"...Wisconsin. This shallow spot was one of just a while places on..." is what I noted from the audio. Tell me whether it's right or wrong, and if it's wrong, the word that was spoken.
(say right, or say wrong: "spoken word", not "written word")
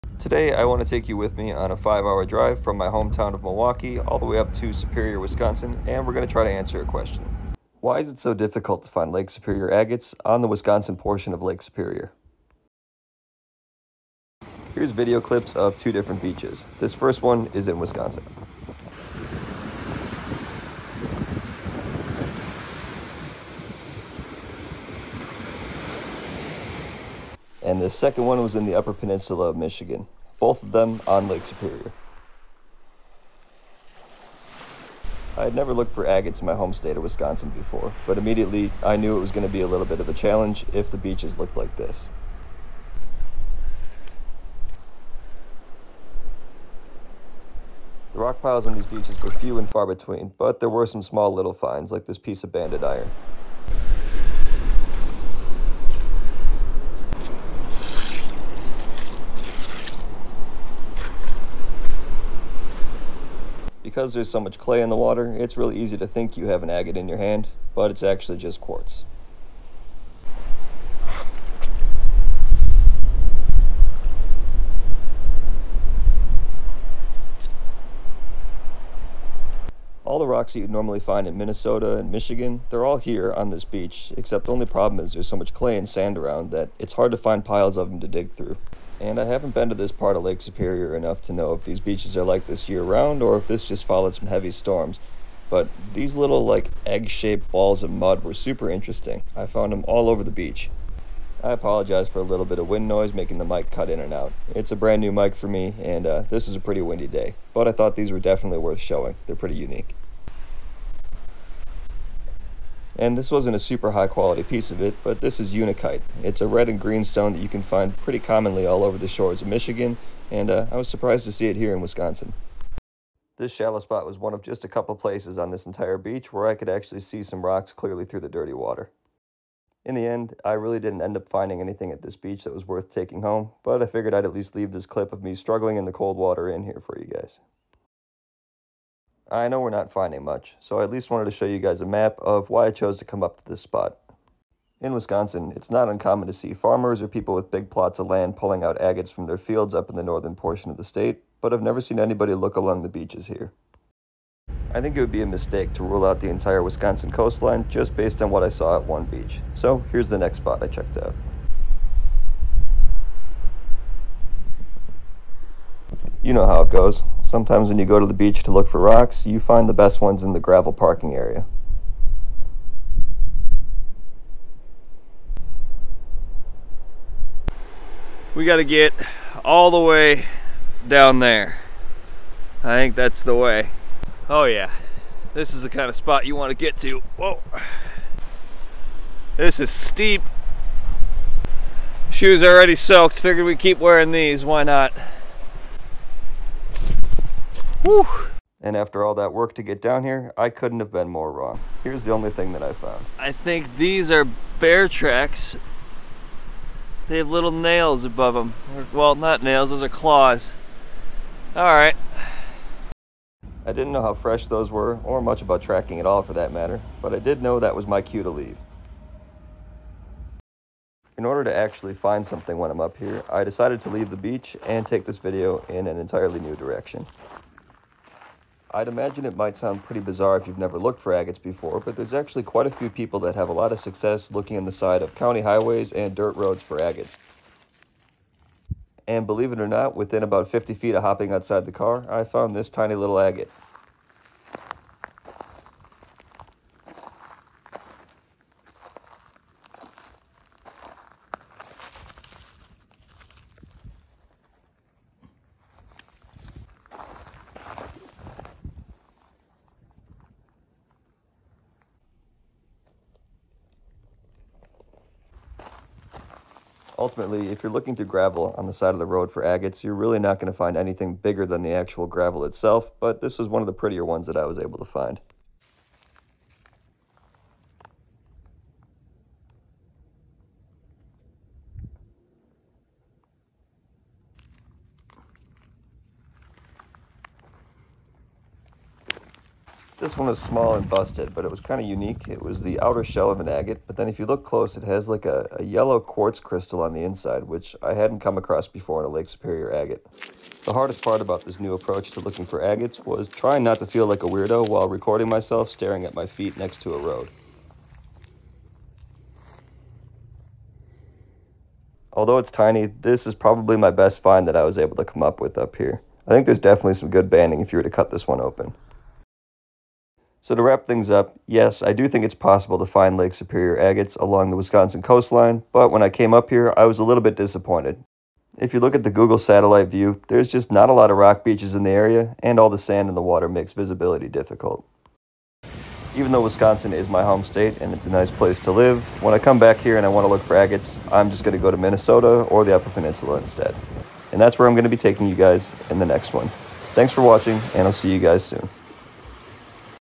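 wrong: "couple", not "while".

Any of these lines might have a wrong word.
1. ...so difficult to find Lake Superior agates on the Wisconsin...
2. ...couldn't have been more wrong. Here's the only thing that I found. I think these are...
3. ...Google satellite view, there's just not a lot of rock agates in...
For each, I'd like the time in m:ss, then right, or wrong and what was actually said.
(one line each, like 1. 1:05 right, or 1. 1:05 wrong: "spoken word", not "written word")
1. 0:08 right
2. 3:20 right
3. 5:29 wrong: "beaches", not "agates".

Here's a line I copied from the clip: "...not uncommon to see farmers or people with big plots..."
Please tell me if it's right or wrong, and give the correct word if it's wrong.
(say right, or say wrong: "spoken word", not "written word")
right.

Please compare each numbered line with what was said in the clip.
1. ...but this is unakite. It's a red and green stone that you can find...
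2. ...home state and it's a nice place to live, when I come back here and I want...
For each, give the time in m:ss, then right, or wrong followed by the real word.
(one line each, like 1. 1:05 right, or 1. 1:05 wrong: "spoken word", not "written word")
1. 1:55 right
2. 5:37 right.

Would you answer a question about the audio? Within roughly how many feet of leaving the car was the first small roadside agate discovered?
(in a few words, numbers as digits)
50 feet.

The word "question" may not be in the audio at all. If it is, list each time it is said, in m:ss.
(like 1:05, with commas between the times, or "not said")
0:06.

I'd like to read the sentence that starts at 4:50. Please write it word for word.
This one was small and busted, but it was kind of unique.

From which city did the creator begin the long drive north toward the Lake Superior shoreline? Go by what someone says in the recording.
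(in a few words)
Milwaukee.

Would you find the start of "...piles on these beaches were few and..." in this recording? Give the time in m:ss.
0:48.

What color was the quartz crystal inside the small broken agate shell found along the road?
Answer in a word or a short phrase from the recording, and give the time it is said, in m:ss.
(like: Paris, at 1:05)
Yellow, at 4:55.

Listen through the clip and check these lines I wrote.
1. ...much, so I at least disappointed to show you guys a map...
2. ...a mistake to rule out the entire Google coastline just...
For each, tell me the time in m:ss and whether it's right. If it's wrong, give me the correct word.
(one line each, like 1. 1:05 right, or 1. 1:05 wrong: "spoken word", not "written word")
1. 2:20 wrong: "wanted", not "disappointed"
2. 2:35 wrong: "Wisconsin", not "Google".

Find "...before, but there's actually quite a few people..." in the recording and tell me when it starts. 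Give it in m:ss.
3:51.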